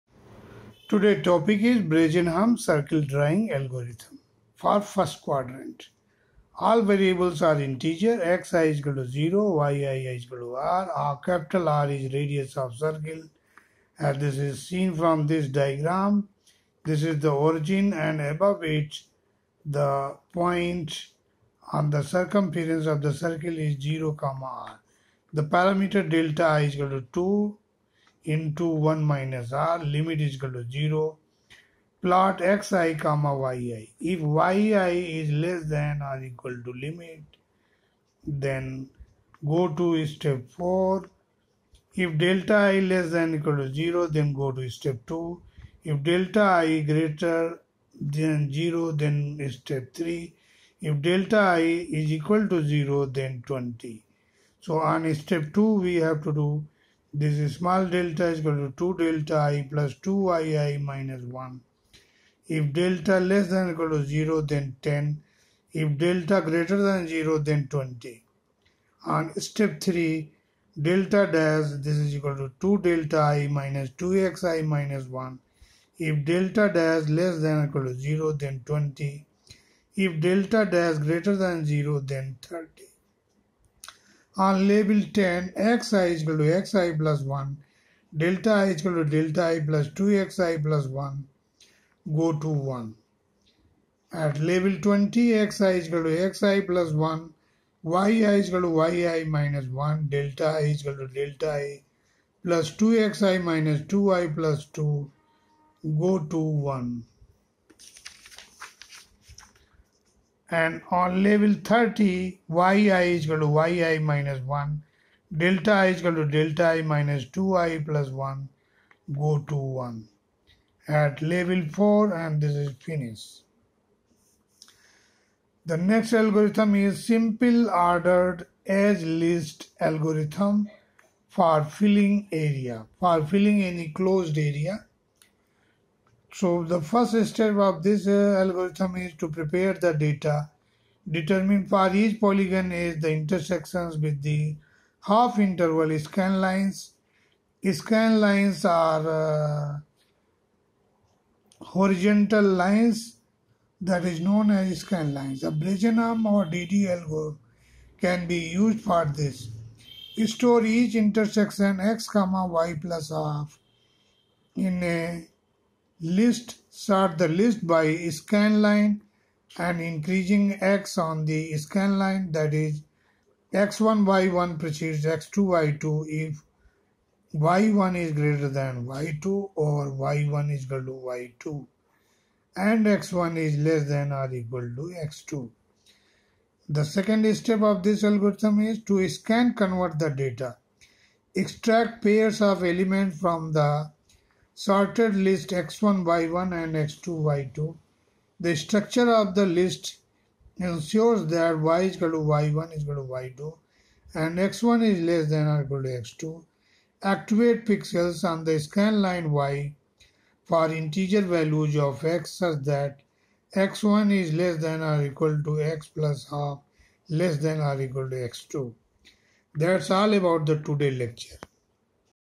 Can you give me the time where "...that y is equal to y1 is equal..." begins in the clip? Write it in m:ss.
3:21.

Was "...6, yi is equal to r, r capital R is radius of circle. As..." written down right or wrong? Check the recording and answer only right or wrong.
wrong.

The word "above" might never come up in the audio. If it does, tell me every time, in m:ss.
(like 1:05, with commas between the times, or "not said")
0:18.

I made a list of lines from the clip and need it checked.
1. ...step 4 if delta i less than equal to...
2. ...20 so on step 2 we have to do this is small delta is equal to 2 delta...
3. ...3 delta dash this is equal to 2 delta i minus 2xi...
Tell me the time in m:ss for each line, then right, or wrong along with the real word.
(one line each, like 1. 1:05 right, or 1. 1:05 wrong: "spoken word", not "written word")
1. 0:40 right
2. 0:53 right
3. 1:09 right.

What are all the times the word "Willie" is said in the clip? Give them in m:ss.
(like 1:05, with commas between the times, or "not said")
not said.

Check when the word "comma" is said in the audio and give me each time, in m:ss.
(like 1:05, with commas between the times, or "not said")
0:24, 0:33, 2:42.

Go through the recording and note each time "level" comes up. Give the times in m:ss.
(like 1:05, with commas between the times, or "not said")
1:51, 2:01.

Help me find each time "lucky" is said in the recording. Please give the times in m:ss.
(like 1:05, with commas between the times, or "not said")
not said.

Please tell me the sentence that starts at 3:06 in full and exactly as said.
The second step of this algorithm is to scan convert the data.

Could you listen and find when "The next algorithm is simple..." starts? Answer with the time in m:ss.
2:05.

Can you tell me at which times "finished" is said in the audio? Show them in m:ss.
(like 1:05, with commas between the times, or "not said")
2:02.